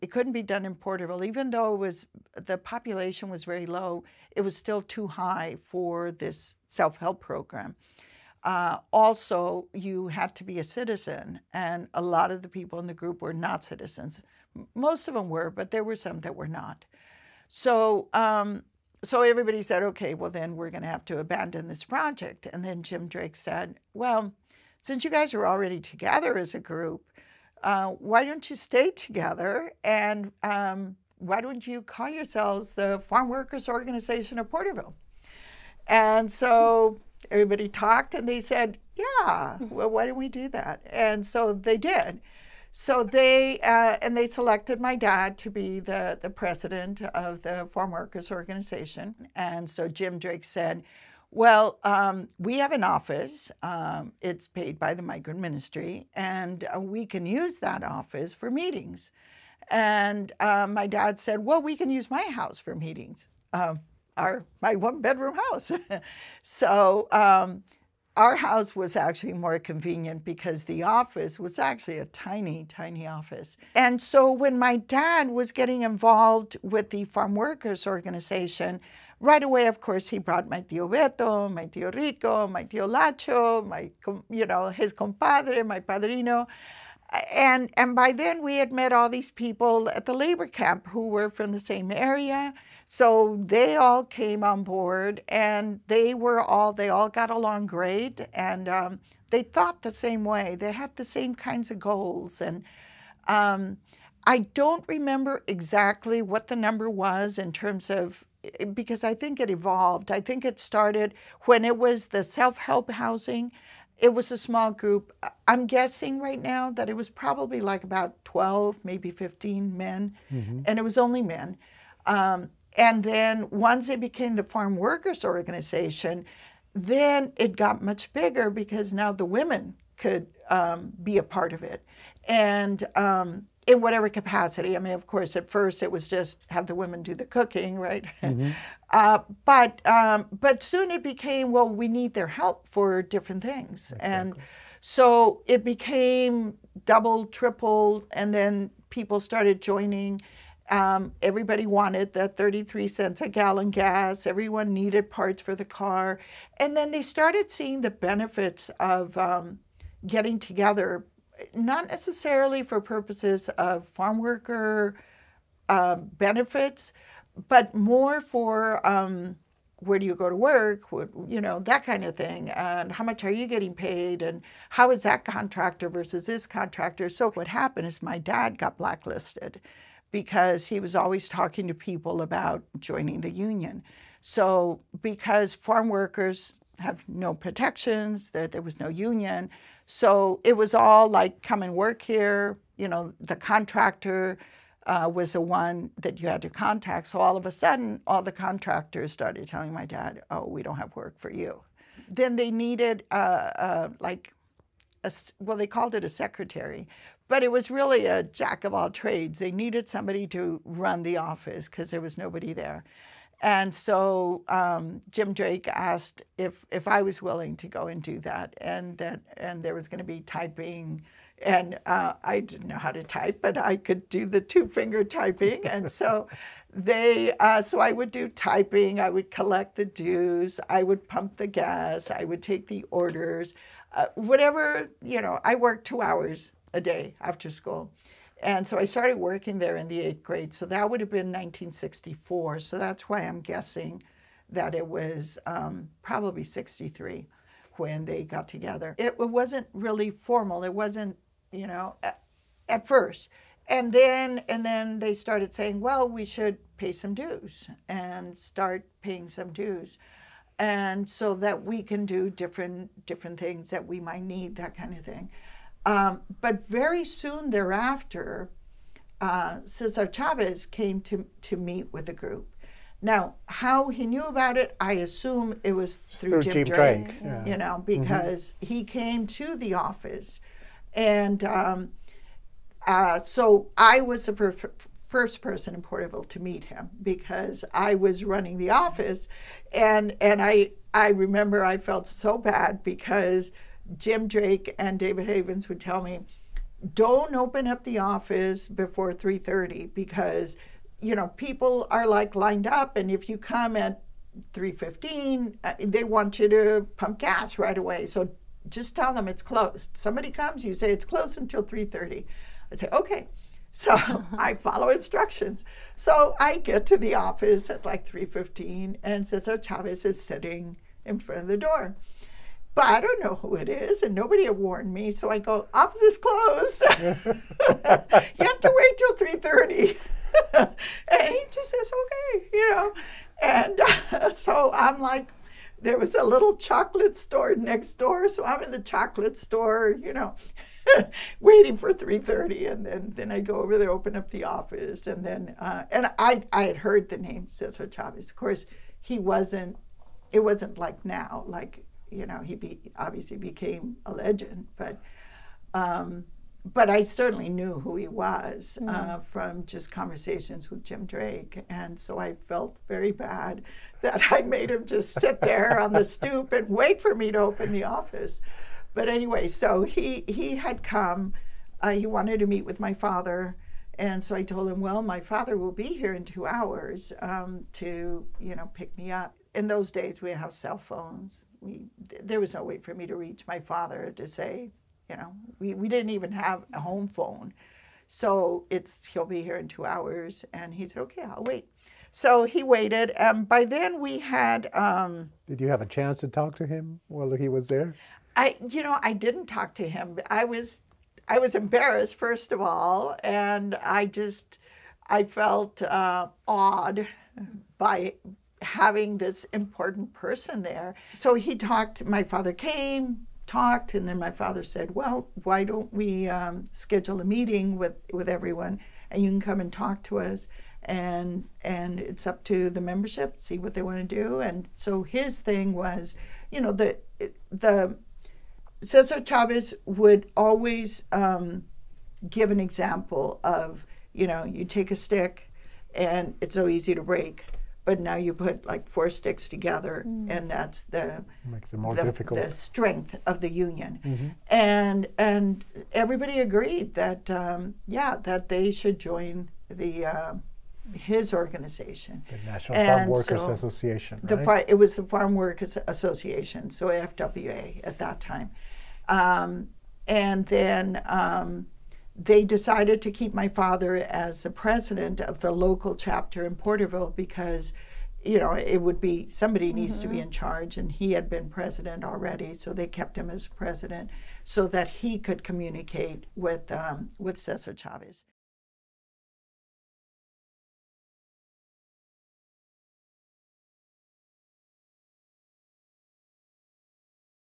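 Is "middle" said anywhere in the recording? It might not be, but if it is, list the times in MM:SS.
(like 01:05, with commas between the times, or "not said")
not said.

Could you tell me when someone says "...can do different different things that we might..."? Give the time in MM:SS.
04:21.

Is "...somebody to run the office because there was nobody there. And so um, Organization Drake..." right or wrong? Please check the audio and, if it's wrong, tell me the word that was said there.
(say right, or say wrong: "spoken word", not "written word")
wrong: "Jim", not "Organization".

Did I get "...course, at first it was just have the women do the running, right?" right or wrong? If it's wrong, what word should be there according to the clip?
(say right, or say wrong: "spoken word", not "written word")
wrong: "cooking", not "running".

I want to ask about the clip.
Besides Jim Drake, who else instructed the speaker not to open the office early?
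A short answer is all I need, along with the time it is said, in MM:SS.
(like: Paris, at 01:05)
David Havens, at 04:54.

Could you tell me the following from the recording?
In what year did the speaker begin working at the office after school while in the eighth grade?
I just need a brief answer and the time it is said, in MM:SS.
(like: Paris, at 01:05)
1964, at 04:01.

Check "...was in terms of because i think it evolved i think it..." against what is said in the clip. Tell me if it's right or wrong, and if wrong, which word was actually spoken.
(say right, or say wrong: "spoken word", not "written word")
right.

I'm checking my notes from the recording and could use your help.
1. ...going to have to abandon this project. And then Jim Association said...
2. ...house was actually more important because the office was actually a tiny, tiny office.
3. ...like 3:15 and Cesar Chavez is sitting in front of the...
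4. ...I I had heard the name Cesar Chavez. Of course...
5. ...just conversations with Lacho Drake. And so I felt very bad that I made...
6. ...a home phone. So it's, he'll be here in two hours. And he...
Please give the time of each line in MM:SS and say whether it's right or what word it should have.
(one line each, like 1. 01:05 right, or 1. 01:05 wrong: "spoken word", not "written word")
1. 00:20 wrong: "Drake", not "Association"
2. 01:08 wrong: "convenient", not "important"
3. 05:17 right
4. 05:46 right
5. 05:59 wrong: "Jim", not "Lacho"
6. 06:26 right.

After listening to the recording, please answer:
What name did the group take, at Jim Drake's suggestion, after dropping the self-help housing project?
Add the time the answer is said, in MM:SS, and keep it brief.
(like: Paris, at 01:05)
Farm Workers Organization of Porterville, at 00:32.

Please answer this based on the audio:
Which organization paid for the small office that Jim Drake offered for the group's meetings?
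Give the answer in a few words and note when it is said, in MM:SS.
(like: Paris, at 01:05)
the migrant ministry, at 00:55.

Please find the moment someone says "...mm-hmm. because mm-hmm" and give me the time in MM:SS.
04:37.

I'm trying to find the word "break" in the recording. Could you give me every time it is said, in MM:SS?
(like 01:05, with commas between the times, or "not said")
07:17.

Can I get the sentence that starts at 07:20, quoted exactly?
and that's the makes it more the, difficult.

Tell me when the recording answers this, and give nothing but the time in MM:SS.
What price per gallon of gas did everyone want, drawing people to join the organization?
02:32.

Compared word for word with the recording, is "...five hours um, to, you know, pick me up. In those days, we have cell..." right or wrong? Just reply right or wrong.
wrong.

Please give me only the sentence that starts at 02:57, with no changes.
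So what happened is my dad got blacklisted because he was always talking to people about joining the union.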